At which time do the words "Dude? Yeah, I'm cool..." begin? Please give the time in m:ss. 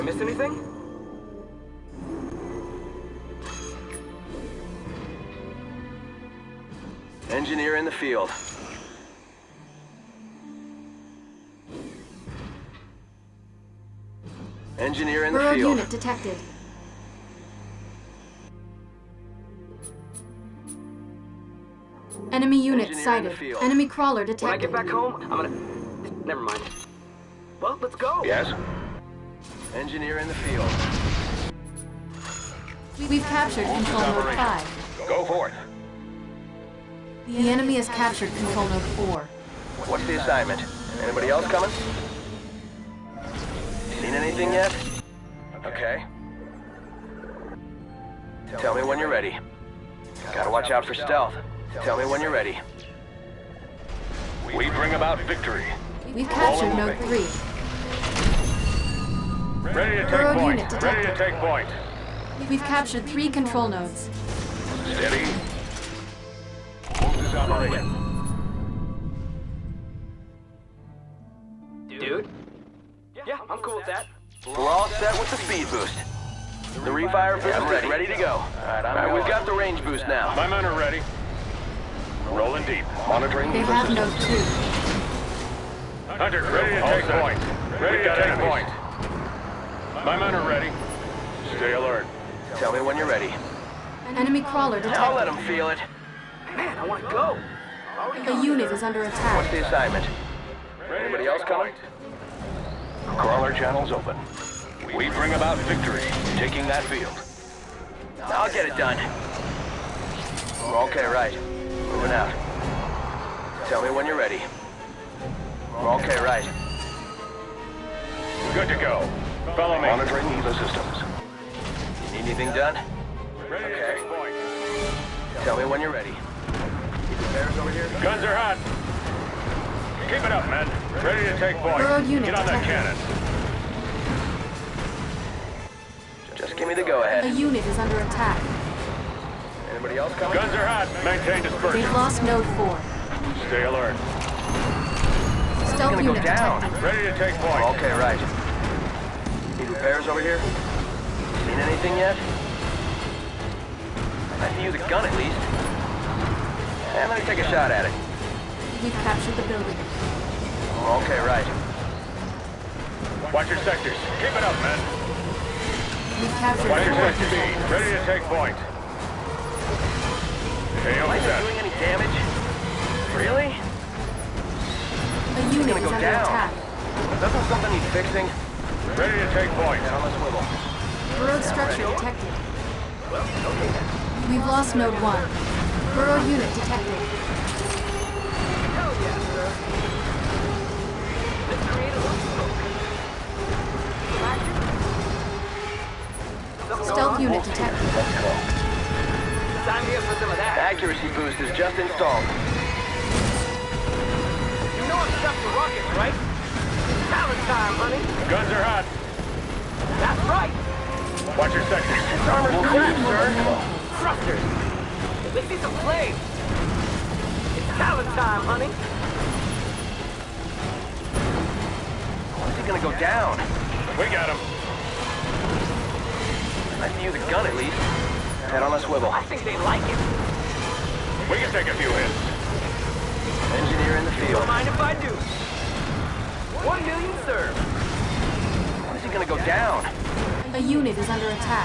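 1:11.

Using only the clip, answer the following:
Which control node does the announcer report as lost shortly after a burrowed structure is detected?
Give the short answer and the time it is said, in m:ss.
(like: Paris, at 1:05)
Node 1, at 3:04.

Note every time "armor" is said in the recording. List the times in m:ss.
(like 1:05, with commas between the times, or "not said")
3:32.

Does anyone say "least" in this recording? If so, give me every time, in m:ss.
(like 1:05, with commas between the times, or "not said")
2:35, 3:47.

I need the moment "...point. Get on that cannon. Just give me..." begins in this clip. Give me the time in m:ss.
2:11.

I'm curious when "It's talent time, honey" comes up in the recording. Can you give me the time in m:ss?
3:37.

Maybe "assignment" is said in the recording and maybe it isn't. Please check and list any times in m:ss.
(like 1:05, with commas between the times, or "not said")
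0:40, 1:39.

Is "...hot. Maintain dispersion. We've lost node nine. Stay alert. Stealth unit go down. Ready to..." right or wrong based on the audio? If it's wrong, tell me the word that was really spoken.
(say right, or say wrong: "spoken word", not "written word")
wrong: "four", not "nine".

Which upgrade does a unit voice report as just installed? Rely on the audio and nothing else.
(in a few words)
Accuracy boost.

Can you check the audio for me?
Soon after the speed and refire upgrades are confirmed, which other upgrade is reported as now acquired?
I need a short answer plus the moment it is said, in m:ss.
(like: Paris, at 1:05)
Range boost, at 1:19.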